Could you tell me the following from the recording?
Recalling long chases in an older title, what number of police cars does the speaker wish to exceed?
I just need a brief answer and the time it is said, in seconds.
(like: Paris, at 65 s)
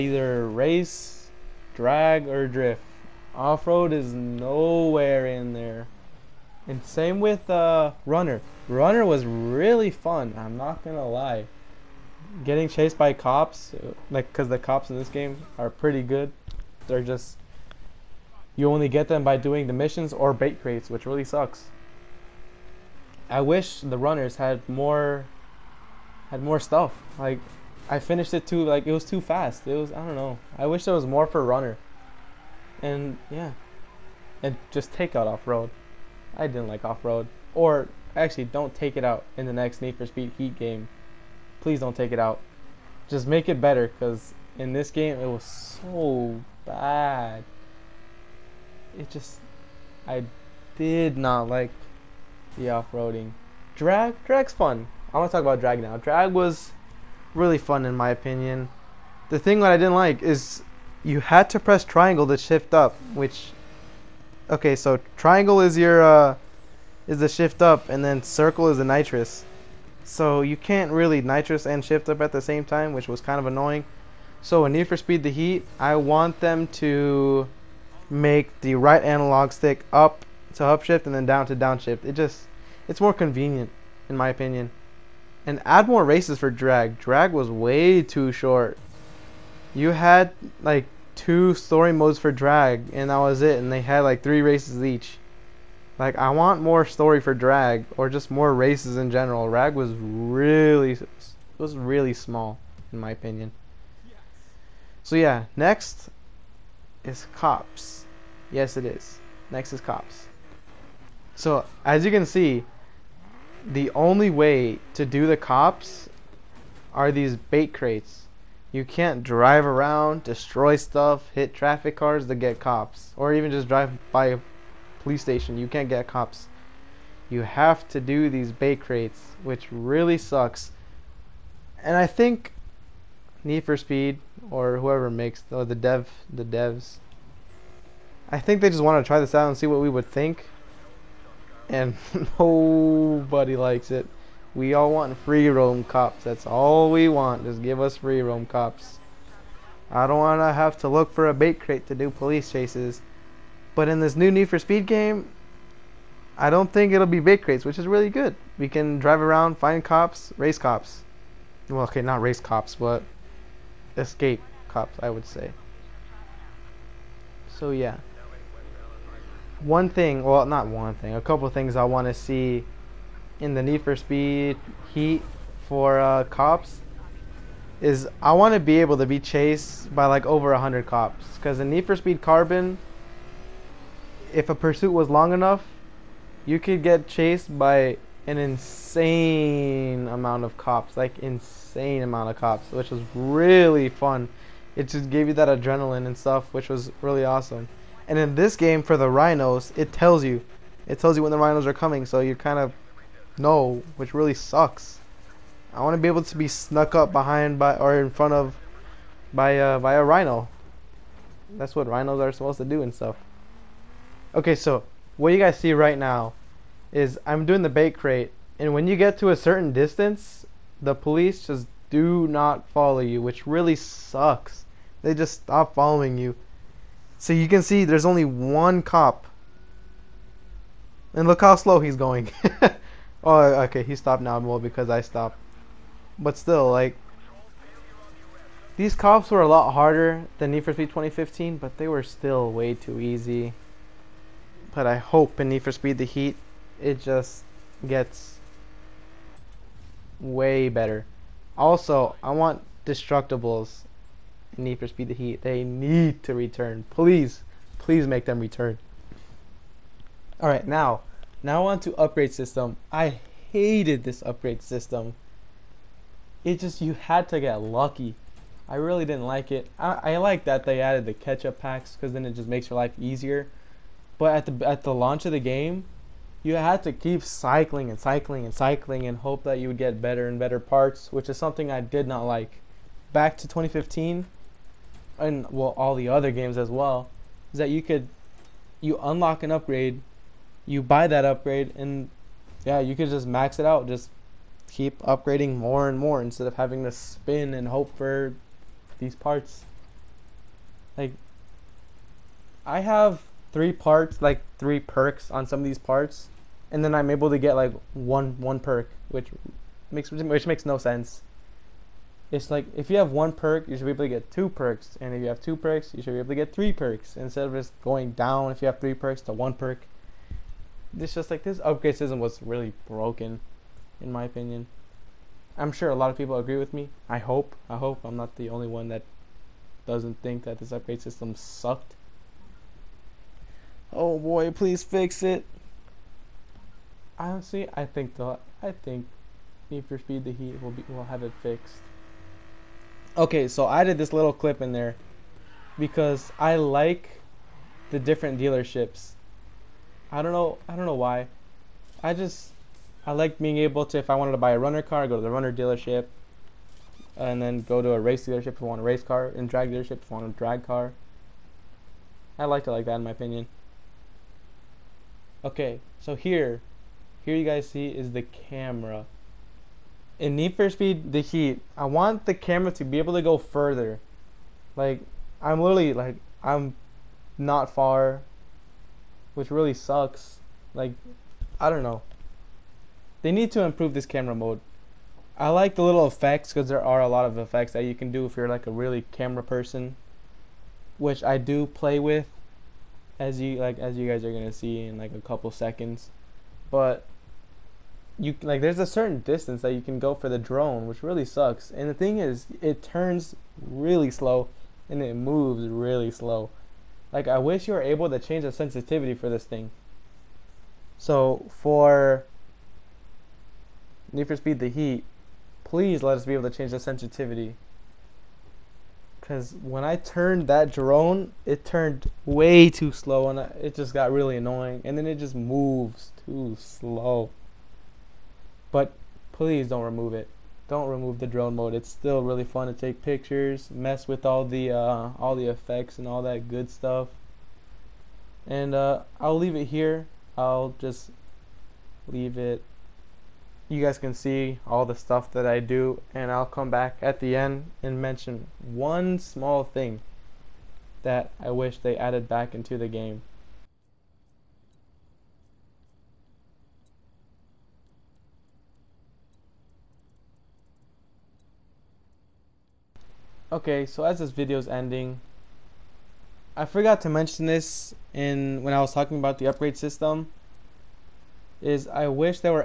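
100, at 180 s.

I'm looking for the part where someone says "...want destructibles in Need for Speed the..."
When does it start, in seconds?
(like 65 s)
252 s.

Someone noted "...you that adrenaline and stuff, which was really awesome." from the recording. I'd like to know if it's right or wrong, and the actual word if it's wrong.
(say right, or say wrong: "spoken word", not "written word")
right.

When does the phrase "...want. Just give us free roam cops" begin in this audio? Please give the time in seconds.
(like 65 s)
147 s.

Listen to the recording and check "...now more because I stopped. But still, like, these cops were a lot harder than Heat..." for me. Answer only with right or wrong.
wrong.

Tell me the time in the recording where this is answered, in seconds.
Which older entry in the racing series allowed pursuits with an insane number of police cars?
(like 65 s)
181 s.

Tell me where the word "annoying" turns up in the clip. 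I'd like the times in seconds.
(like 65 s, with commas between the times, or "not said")
73 s, 424 s.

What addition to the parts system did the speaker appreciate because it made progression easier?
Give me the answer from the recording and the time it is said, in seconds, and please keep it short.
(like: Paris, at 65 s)
Catch-up packs, at 271 s.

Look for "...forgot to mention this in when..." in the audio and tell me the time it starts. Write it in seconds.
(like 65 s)
466 s.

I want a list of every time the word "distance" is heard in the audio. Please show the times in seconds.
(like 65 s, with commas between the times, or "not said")
219 s, 399 s.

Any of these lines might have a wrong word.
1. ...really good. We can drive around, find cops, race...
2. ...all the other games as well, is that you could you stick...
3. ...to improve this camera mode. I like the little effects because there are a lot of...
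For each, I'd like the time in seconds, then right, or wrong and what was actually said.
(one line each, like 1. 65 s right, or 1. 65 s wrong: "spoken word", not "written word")
1. 157 s right
2. 285 s wrong: "unlock", not "stick"
3. 383 s right.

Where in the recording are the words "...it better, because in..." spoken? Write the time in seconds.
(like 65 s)
43 s.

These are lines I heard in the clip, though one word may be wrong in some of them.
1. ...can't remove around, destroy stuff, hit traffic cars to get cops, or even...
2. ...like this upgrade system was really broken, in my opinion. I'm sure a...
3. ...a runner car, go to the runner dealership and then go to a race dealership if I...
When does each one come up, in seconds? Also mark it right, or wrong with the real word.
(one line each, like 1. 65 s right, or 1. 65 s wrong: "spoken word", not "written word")
1. 118 s wrong: "drive", not "remove"
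2. 321 s right
3. 354 s right.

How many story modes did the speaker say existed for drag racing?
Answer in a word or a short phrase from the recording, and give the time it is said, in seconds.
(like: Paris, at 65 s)
2, at 91 s.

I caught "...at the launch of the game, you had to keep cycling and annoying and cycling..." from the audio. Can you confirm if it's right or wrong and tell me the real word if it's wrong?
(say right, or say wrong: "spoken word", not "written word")
wrong: "cycling", not "annoying".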